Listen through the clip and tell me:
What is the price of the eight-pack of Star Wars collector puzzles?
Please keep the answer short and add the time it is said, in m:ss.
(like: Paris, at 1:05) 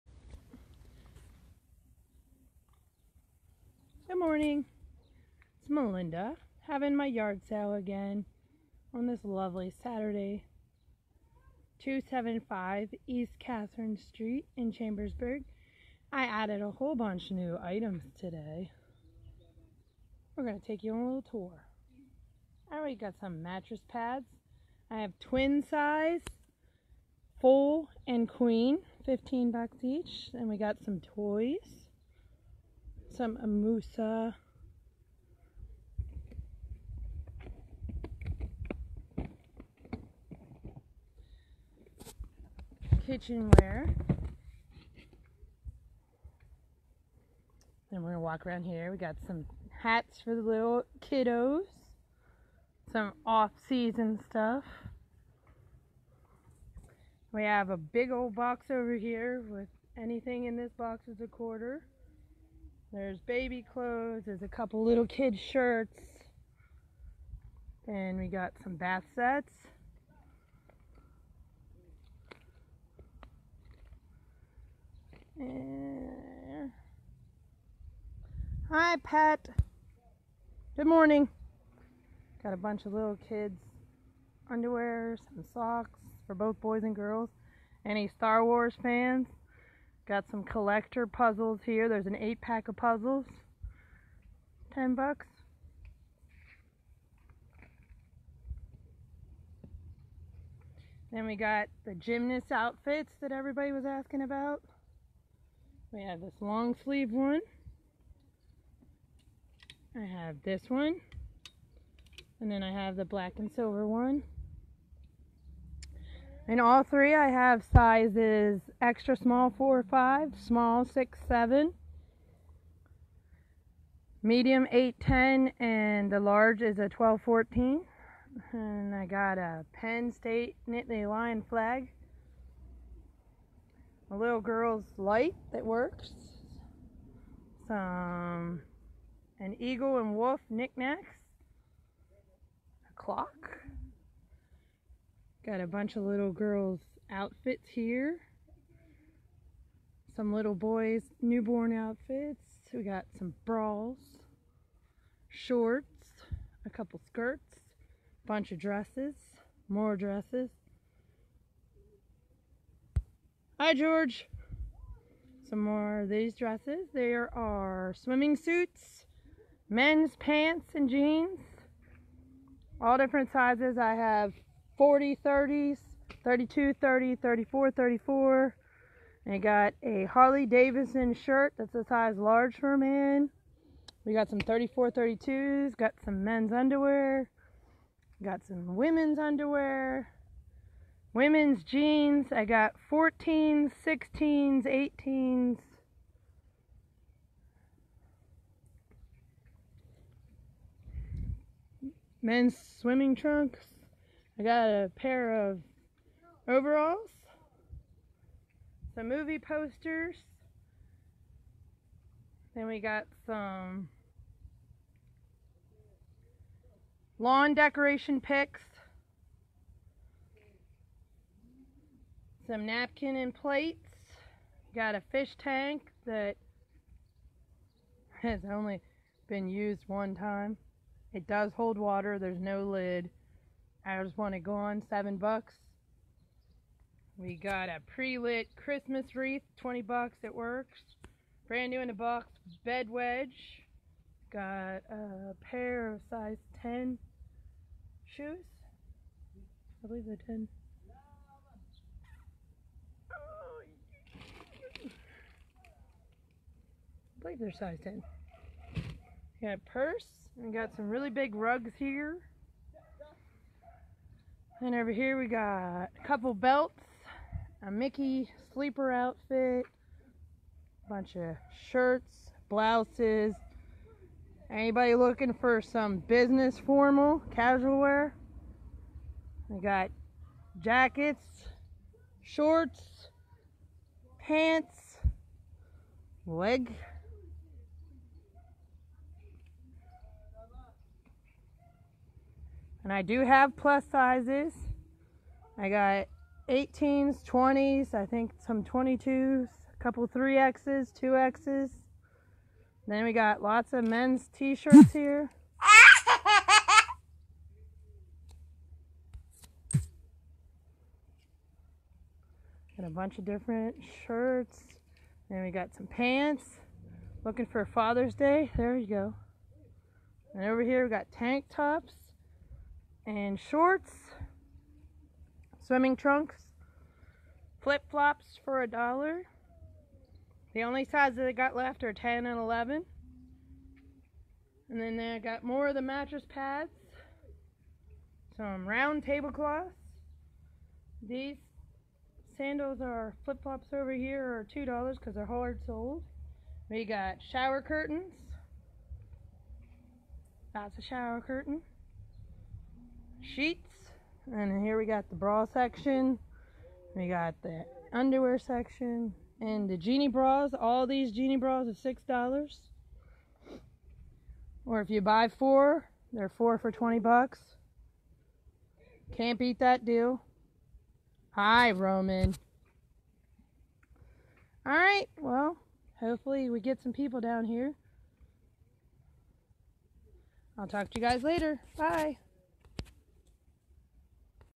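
$10, at 1:34.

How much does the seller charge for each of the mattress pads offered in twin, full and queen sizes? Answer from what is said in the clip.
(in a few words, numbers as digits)
$15.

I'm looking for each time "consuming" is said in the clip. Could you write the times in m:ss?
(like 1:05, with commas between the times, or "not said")
not said.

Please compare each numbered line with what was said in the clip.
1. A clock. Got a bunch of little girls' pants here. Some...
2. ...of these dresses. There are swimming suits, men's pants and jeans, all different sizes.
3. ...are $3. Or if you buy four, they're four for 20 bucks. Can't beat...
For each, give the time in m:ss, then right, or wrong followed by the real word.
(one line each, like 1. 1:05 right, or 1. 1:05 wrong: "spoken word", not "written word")
1. 2:22 wrong: "outfits", not "pants"
2. 2:46 right
3. 6:01 wrong: "6", not "3".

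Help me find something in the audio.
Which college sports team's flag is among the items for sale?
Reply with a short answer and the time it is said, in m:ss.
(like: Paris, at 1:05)
Penn State Nittany Lion, at 2:09.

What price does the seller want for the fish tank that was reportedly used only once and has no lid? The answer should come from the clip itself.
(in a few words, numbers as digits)
$7.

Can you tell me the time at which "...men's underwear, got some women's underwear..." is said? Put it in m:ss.
3:06.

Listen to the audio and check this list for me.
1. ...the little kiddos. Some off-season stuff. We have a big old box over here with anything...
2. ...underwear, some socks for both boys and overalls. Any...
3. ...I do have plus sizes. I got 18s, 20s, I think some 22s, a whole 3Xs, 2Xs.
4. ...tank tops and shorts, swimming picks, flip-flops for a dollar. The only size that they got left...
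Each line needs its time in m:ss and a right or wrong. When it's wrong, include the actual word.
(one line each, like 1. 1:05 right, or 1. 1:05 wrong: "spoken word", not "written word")
1. 0:50 right
2. 1:24 wrong: "girls", not "overalls"
3. 4:52 wrong: "couple", not "whole"
4. 5:21 wrong: "trunks", not "picks".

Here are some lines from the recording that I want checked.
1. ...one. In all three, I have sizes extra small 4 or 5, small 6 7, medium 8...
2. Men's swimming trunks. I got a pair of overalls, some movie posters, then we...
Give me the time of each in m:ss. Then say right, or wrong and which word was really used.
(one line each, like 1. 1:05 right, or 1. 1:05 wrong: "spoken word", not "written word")
1. 1:53 right
2. 3:22 right.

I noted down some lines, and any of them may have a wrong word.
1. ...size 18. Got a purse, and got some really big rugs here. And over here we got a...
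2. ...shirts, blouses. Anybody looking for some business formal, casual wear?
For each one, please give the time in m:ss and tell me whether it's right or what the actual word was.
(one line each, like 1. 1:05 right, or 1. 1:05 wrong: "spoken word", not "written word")
1. 4:17 wrong: "10", not "18"
2. 4:31 right.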